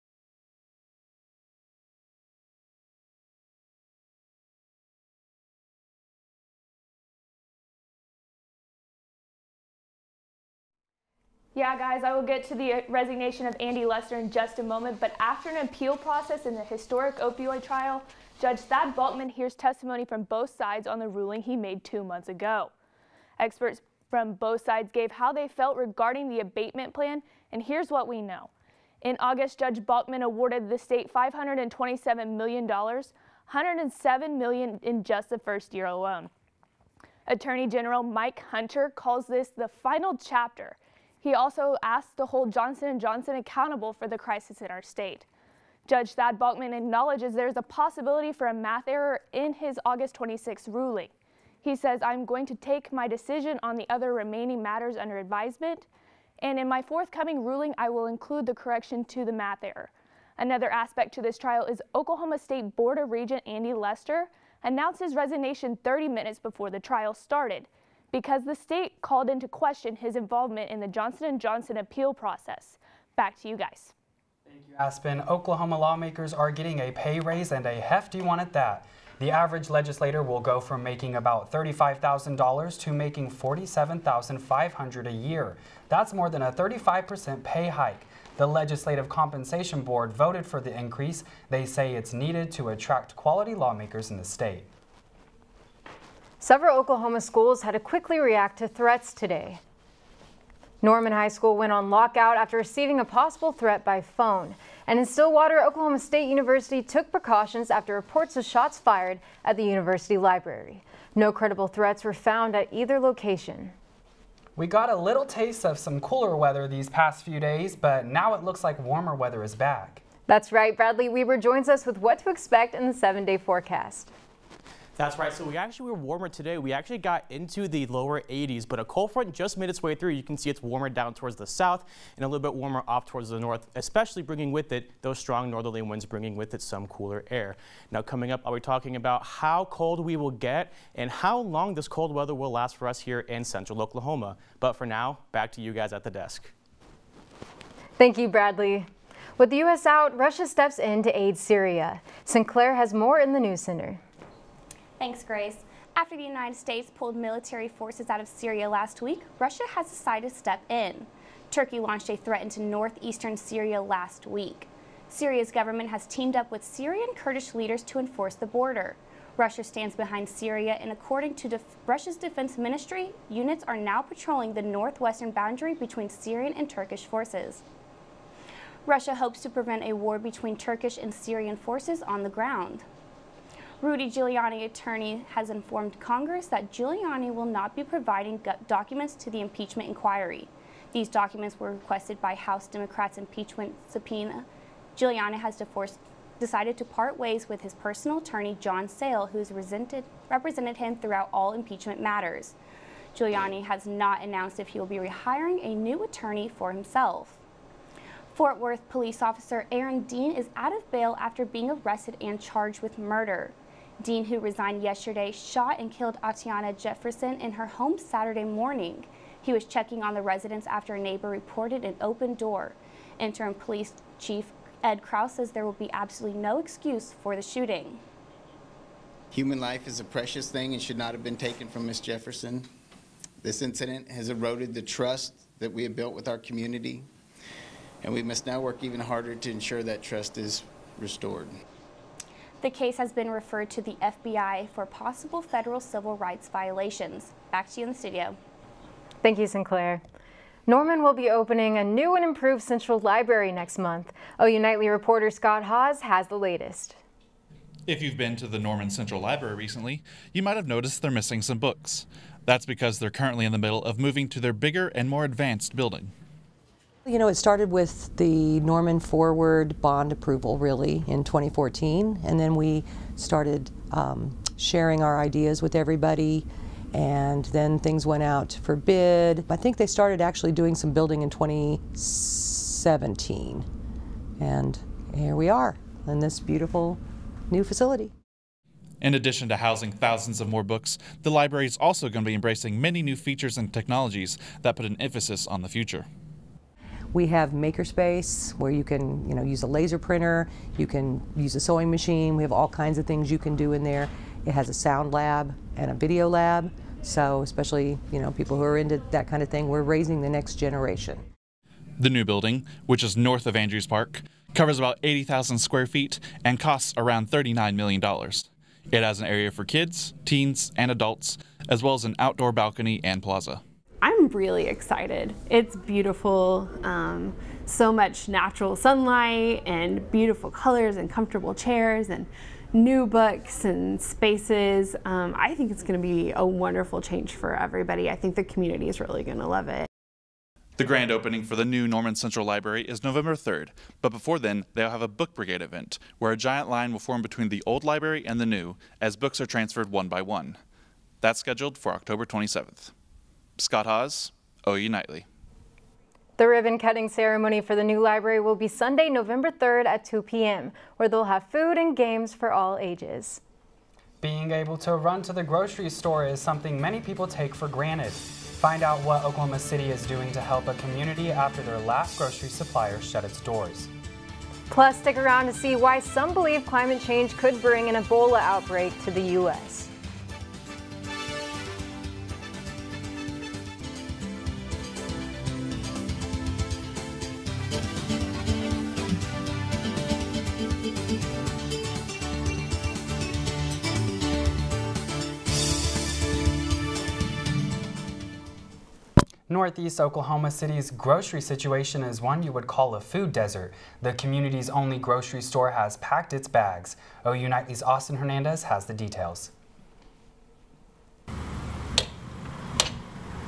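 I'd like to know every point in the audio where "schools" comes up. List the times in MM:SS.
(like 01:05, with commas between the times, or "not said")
01:37, 01:41.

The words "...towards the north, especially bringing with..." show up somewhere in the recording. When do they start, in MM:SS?
02:13.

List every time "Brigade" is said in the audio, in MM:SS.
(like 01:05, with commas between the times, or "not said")
05:45.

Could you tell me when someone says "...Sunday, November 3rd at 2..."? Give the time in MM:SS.
05:58.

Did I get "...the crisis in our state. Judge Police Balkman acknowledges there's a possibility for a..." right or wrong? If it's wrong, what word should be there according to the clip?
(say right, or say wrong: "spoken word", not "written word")
wrong: "Thad", not "Police".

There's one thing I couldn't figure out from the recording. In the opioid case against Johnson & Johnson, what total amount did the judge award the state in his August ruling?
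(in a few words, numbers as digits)
$527 million.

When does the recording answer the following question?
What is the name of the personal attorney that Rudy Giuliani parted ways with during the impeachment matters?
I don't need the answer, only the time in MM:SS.
03:18.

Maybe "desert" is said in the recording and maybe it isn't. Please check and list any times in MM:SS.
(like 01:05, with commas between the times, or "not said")
06:43.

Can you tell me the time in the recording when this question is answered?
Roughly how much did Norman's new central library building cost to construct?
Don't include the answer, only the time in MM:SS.
05:17.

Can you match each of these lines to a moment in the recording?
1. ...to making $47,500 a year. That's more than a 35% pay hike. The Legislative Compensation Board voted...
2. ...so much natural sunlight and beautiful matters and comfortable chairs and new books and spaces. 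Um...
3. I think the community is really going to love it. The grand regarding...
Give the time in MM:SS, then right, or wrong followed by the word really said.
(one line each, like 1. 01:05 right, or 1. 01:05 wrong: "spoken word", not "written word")
1. 01:22 right
2. 05:27 wrong: "colors", not "matters"
3. 05:38 wrong: "opening", not "regarding".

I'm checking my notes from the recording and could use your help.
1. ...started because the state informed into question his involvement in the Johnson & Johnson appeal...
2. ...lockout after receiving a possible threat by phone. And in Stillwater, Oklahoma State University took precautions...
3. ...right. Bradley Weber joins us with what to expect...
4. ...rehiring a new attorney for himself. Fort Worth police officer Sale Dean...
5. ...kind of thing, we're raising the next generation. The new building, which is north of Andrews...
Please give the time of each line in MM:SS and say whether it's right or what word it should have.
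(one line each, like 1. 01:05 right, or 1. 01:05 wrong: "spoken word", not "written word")
1. 01:07 wrong: "called", not "informed"
2. 01:41 right
3. 02:00 right
4. 03:24 wrong: "Aaron", not "Sale"
5. 05:09 right.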